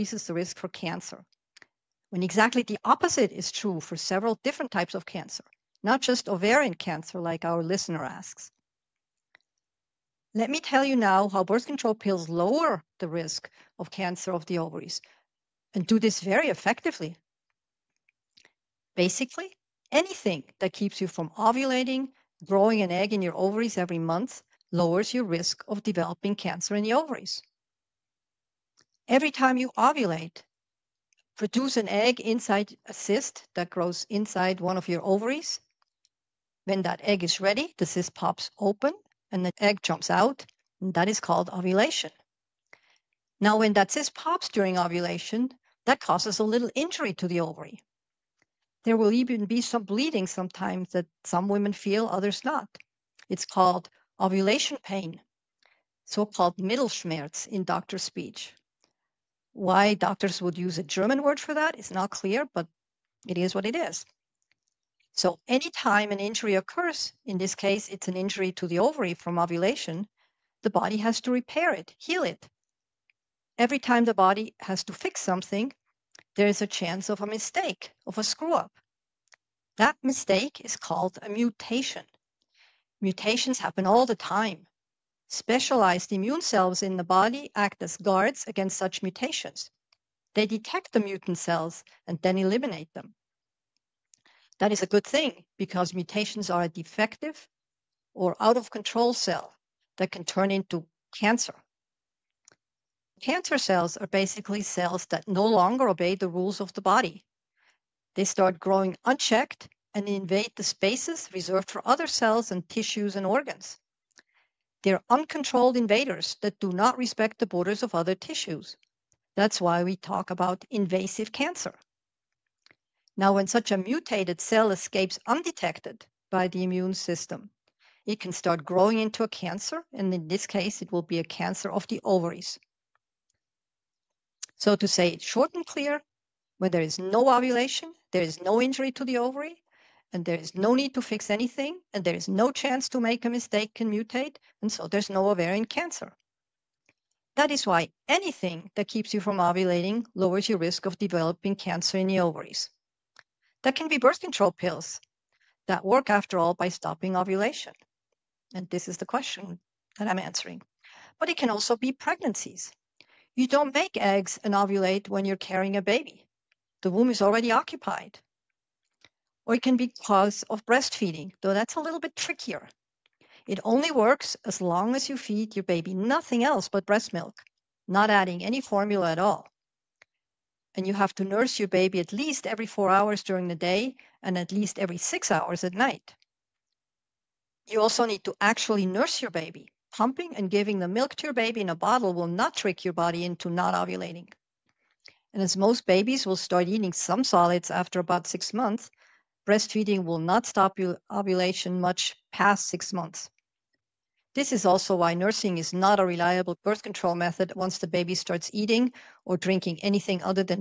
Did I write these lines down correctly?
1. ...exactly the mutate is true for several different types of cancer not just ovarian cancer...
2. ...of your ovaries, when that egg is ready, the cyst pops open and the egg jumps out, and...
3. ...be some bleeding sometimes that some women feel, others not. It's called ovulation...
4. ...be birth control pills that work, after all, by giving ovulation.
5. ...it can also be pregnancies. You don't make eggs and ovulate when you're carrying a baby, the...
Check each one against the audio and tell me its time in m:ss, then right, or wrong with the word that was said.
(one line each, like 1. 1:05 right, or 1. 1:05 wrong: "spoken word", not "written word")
1. 0:02 wrong: "opposite", not "mutate"
2. 0:34 right
3. 0:49 right
4. 2:33 wrong: "stopping", not "giving"
5. 2:41 right.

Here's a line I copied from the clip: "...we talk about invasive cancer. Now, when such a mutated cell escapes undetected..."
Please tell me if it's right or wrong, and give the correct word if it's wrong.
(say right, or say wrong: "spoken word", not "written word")
right.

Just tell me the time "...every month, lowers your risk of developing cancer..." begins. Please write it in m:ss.
0:23.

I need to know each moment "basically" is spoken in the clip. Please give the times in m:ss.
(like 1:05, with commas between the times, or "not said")
0:18, 1:44.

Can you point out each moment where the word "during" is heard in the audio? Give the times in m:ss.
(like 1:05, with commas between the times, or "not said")
0:44, 3:03.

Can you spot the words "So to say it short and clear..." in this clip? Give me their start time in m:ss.
2:14.